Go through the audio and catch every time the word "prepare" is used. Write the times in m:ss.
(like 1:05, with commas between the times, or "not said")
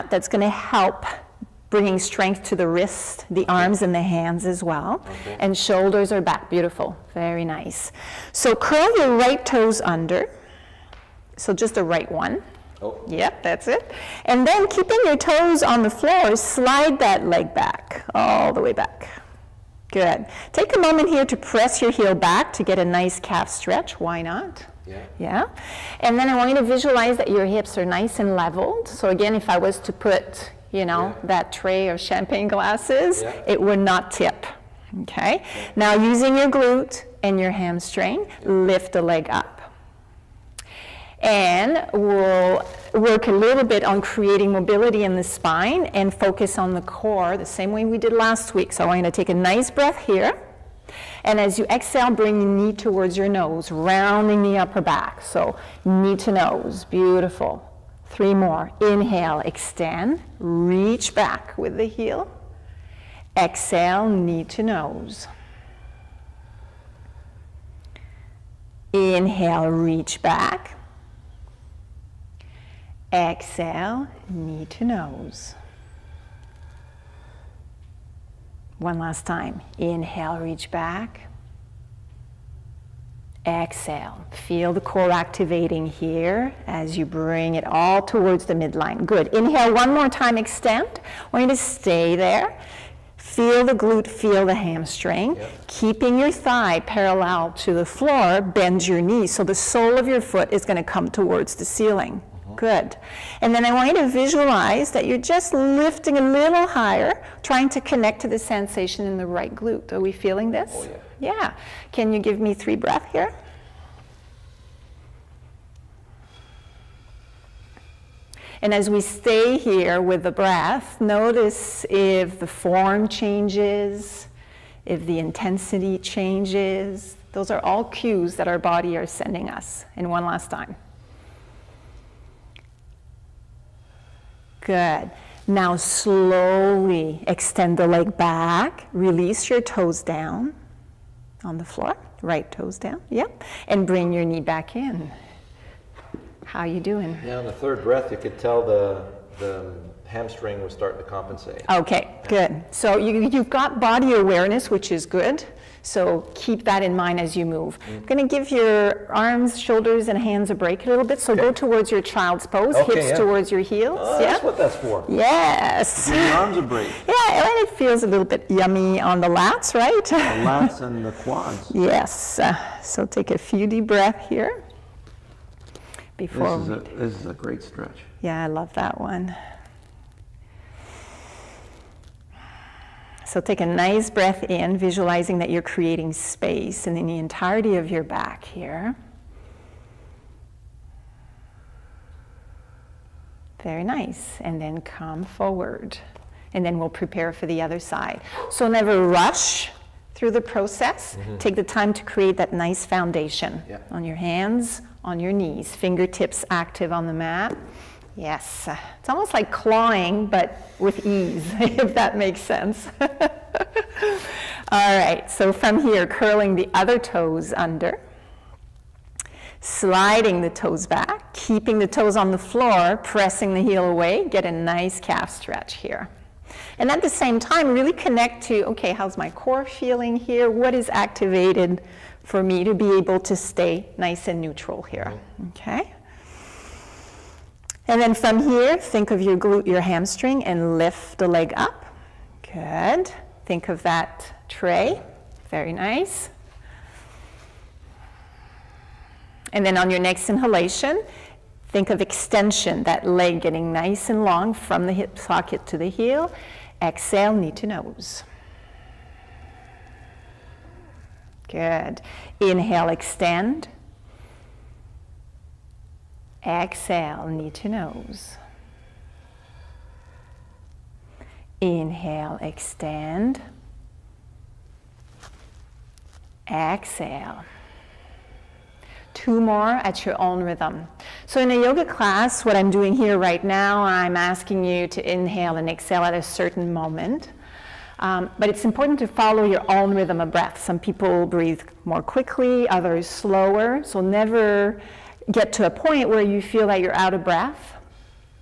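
3:16.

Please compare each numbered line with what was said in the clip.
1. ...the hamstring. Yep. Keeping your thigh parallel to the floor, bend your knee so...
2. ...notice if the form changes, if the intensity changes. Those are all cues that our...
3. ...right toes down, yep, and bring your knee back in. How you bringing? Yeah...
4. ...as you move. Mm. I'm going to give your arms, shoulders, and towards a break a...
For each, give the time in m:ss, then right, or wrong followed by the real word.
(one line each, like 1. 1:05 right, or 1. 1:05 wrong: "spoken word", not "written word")
1. 1:34 right
2. 2:00 right
3. 2:22 wrong: "doing", not "bringing"
4. 2:37 wrong: "hands", not "towards".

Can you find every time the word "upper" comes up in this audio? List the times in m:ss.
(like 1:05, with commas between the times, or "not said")
0:54.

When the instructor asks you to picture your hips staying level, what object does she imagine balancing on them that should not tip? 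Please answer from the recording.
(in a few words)
Tray of champagne glasses.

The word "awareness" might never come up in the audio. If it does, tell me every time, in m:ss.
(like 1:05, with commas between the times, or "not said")
2:34.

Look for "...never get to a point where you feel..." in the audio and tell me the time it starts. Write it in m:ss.
4:53.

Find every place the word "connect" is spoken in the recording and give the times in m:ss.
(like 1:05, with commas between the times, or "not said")
1:47, 3:47.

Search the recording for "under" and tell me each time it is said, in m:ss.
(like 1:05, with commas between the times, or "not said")
0:09, 3:37.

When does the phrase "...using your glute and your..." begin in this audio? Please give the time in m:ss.
0:35.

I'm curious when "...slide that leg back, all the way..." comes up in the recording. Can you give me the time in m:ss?
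0:16.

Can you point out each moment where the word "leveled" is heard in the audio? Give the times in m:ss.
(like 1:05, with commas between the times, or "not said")
0:28.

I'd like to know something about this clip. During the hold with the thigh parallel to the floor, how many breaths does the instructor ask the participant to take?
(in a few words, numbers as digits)
3.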